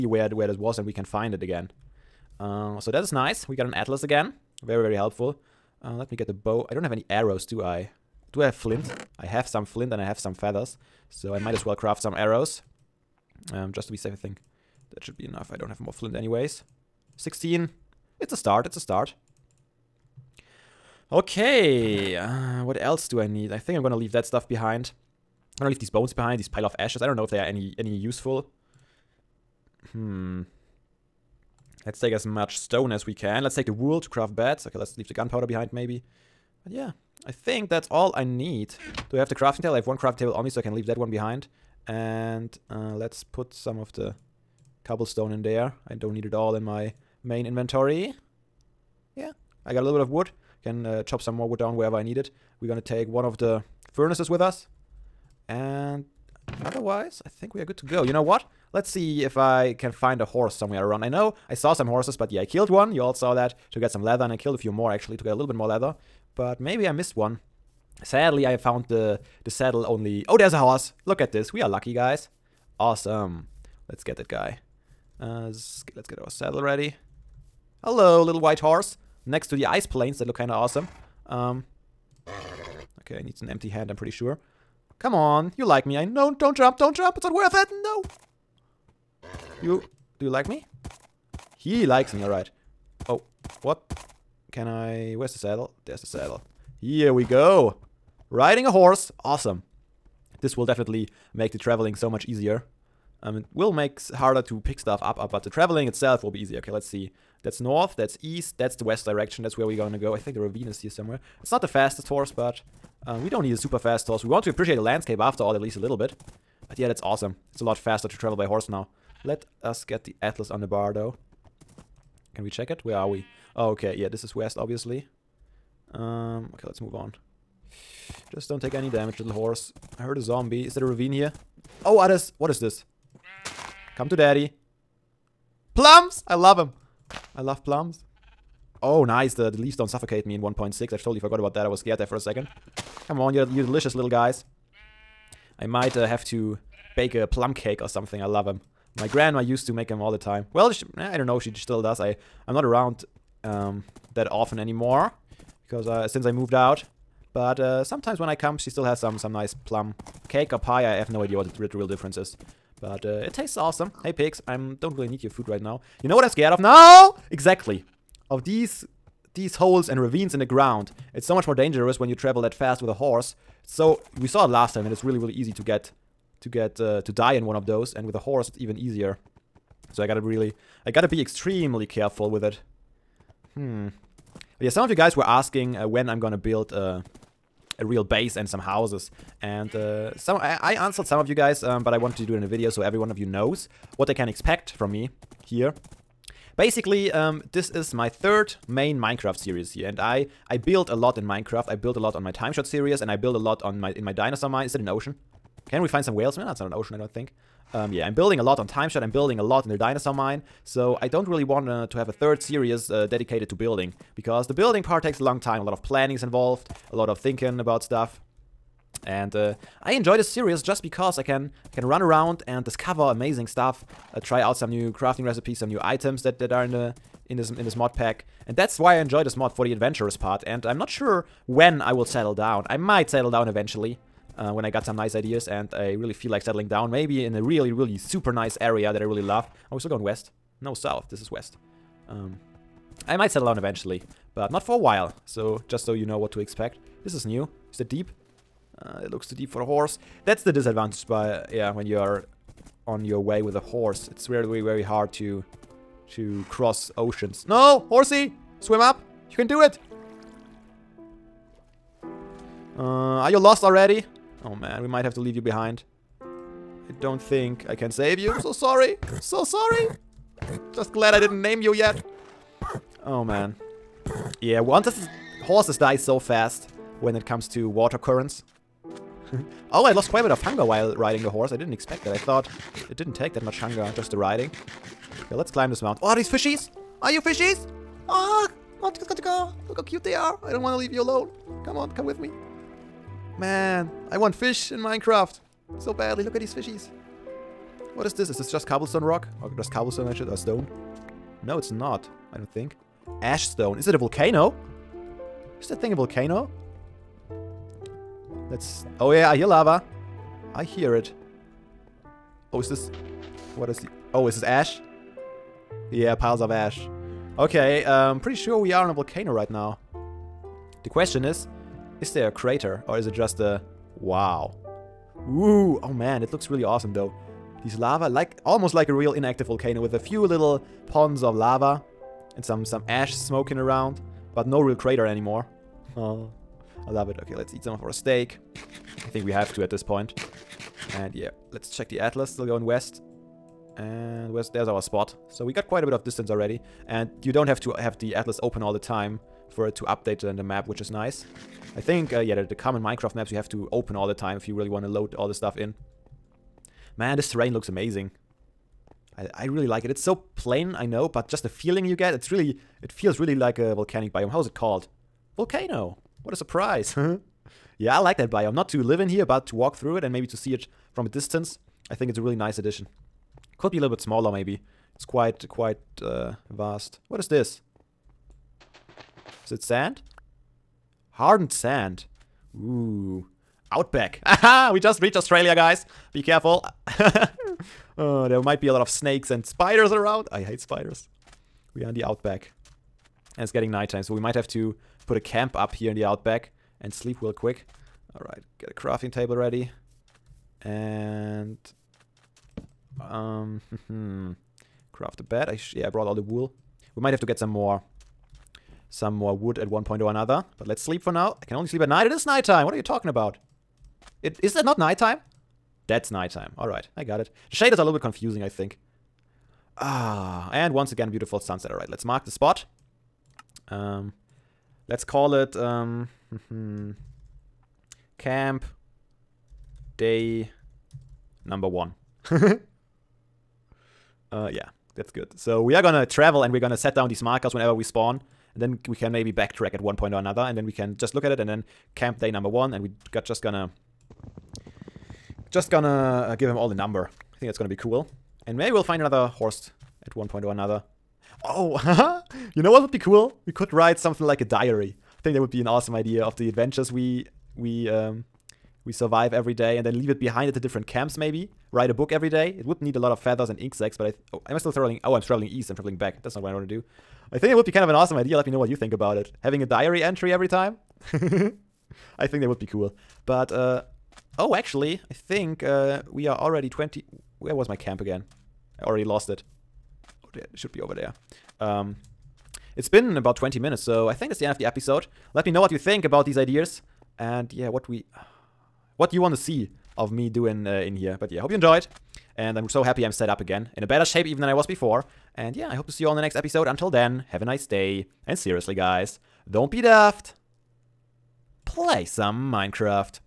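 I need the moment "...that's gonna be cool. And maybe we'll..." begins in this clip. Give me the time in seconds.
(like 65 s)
447 s.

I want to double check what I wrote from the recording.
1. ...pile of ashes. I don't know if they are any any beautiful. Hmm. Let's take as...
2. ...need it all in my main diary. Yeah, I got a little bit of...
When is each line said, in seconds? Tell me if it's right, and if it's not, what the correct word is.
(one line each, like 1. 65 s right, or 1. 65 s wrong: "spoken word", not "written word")
1. 26 s wrong: "useful", not "beautiful"
2. 46 s wrong: "inventory", not "diary".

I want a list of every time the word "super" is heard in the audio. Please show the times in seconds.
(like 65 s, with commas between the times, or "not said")
113 s, 237 s.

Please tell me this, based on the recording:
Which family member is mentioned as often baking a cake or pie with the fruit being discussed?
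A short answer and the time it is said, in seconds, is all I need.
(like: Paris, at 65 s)
Grandma, at 149 s.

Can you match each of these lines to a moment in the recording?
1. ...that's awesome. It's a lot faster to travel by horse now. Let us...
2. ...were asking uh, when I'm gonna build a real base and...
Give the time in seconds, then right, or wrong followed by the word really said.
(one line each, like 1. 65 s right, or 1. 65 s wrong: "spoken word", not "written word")
1. 116 s right
2. 185 s right.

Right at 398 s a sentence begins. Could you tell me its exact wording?
Alright, get a crafting table ready.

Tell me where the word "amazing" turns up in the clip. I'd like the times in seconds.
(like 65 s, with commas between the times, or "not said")
223 s, 357 s.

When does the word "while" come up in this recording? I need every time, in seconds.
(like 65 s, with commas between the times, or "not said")
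244 s, 280 s.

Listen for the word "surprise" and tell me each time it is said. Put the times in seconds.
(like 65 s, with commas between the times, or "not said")
366 s.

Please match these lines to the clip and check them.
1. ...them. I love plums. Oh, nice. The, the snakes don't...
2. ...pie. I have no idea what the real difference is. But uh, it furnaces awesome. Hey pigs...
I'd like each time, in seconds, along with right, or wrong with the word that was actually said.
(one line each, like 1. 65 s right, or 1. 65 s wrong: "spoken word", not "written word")
1. 136 s wrong: "leaves", not "snakes"
2. 160 s wrong: "tastes", not "furnaces".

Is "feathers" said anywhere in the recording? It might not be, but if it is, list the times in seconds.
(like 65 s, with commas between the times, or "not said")
10 s, 463 s.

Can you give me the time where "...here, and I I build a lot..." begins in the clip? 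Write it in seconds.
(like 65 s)
199 s.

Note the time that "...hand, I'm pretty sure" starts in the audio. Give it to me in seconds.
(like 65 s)
83 s.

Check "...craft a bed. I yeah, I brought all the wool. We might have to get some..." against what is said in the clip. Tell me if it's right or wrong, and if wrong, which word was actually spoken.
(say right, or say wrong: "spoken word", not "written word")
right.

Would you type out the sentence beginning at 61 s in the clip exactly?
I know I saw some horses, but yeah, I killed one.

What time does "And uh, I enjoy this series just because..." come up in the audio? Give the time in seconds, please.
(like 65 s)
219 s.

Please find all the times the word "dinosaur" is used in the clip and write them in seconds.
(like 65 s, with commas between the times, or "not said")
204 s, 209 s.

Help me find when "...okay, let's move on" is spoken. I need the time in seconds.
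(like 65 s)
126 s.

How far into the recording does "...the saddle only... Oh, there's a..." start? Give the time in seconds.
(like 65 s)
69 s.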